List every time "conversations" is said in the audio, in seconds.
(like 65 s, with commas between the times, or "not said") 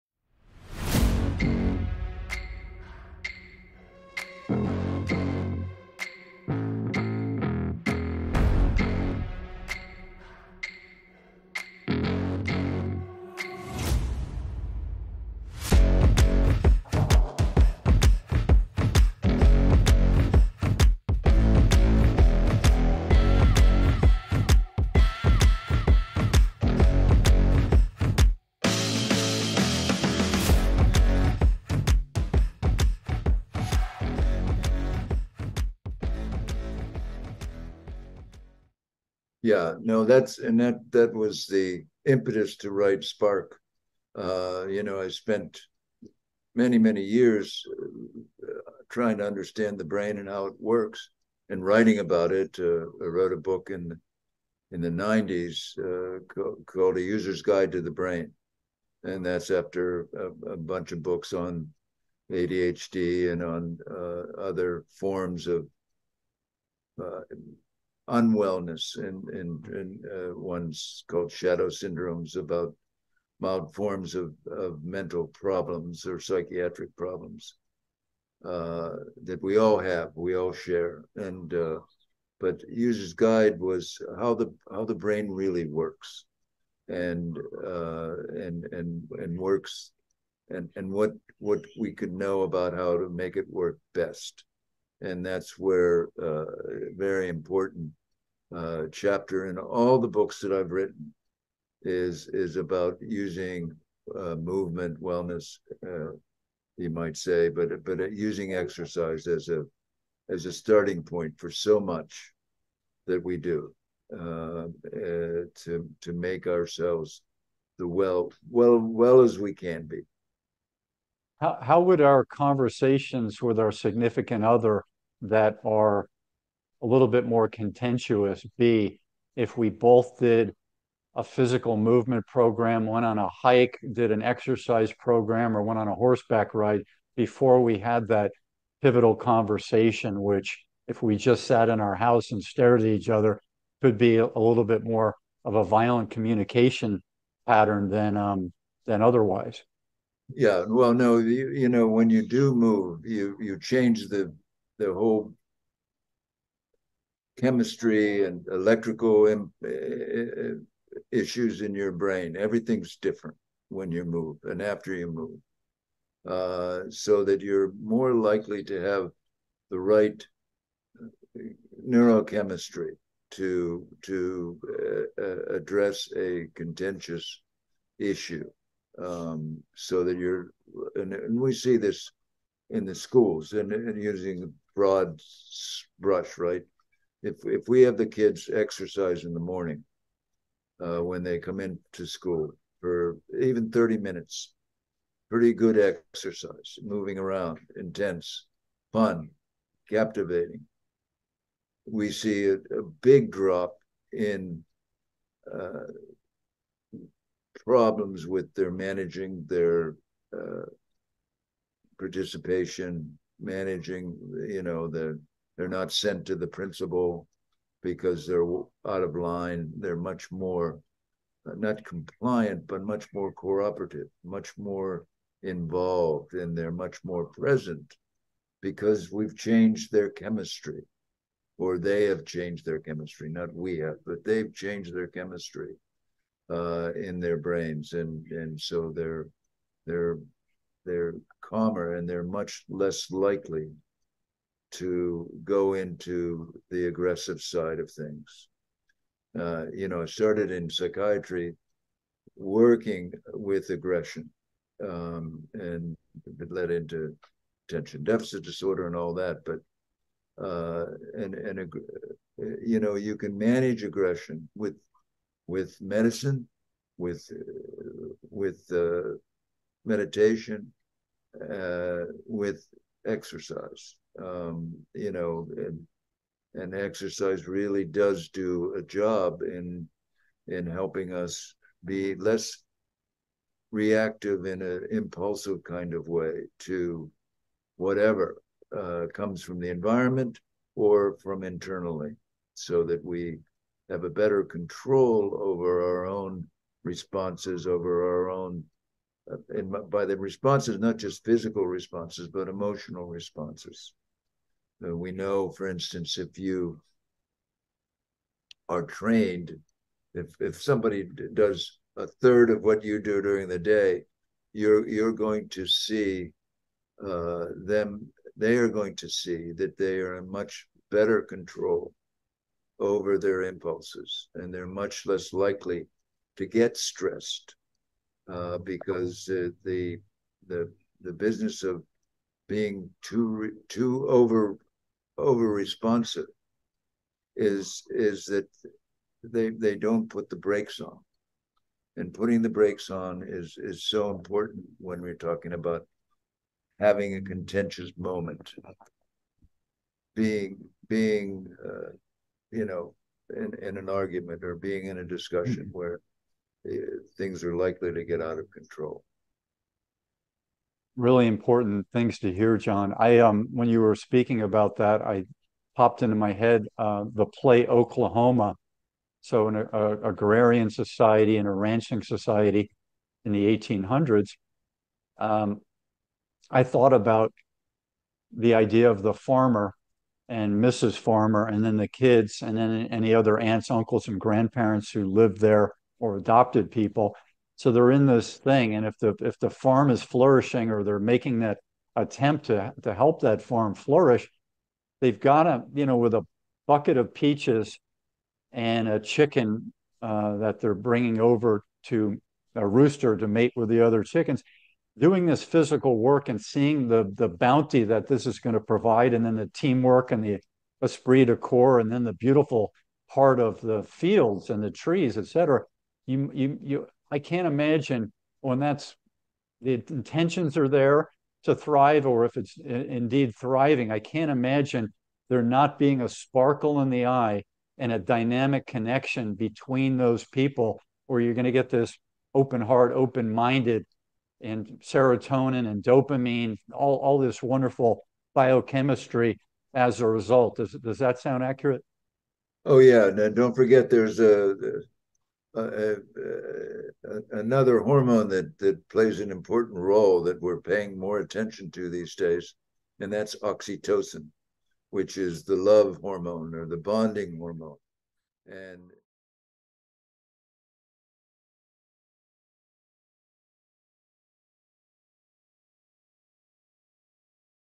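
122 s, 139 s.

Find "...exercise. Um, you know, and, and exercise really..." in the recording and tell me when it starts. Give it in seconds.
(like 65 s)
273 s.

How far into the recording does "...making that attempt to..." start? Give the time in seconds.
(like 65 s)
390 s.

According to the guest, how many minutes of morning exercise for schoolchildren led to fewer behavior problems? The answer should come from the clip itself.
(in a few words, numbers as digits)
30.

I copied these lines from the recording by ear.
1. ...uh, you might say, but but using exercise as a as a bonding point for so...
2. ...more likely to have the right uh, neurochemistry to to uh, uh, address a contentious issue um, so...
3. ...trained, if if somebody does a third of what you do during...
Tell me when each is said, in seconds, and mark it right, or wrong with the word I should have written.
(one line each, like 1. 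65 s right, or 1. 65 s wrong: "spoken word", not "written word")
1. 105 s wrong: "starting", not "bonding"
2. 167 s right
3. 308 s right.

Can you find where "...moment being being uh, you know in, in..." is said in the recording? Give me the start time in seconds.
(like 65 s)
347 s.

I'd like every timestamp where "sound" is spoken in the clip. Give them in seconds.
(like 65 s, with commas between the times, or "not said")
441 s.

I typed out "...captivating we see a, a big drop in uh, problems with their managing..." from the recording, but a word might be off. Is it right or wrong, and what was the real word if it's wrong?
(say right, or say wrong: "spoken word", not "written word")
right.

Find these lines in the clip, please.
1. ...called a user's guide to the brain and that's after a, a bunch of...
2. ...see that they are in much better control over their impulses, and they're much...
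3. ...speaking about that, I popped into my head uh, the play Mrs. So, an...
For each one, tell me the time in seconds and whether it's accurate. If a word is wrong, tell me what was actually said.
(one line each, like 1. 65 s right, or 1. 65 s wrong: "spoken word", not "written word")
1. 56 s right
2. 319 s right
3. 363 s wrong: "Oklahoma", not "Mrs".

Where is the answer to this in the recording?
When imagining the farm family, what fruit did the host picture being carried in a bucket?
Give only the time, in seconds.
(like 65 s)
397 s.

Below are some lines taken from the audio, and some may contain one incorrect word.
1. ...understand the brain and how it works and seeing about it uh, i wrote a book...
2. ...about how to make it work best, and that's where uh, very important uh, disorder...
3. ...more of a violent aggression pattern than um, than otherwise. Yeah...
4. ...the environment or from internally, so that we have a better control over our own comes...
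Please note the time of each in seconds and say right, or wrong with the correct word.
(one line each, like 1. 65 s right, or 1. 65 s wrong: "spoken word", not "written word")
1. 49 s wrong: "writing", not "seeing"
2. 92 s wrong: "chapter", not "disorder"
3. 144 s wrong: "communication", not "aggression"
4. 289 s wrong: "responses", not "comes".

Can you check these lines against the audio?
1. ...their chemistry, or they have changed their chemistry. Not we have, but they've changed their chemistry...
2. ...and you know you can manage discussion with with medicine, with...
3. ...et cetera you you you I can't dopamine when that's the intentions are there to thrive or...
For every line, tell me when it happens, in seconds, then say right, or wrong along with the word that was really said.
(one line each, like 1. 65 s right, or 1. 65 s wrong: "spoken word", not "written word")
1. 229 s right
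2. 261 s wrong: "aggression", not "discussion"
3. 415 s wrong: "imagine", not "dopamine".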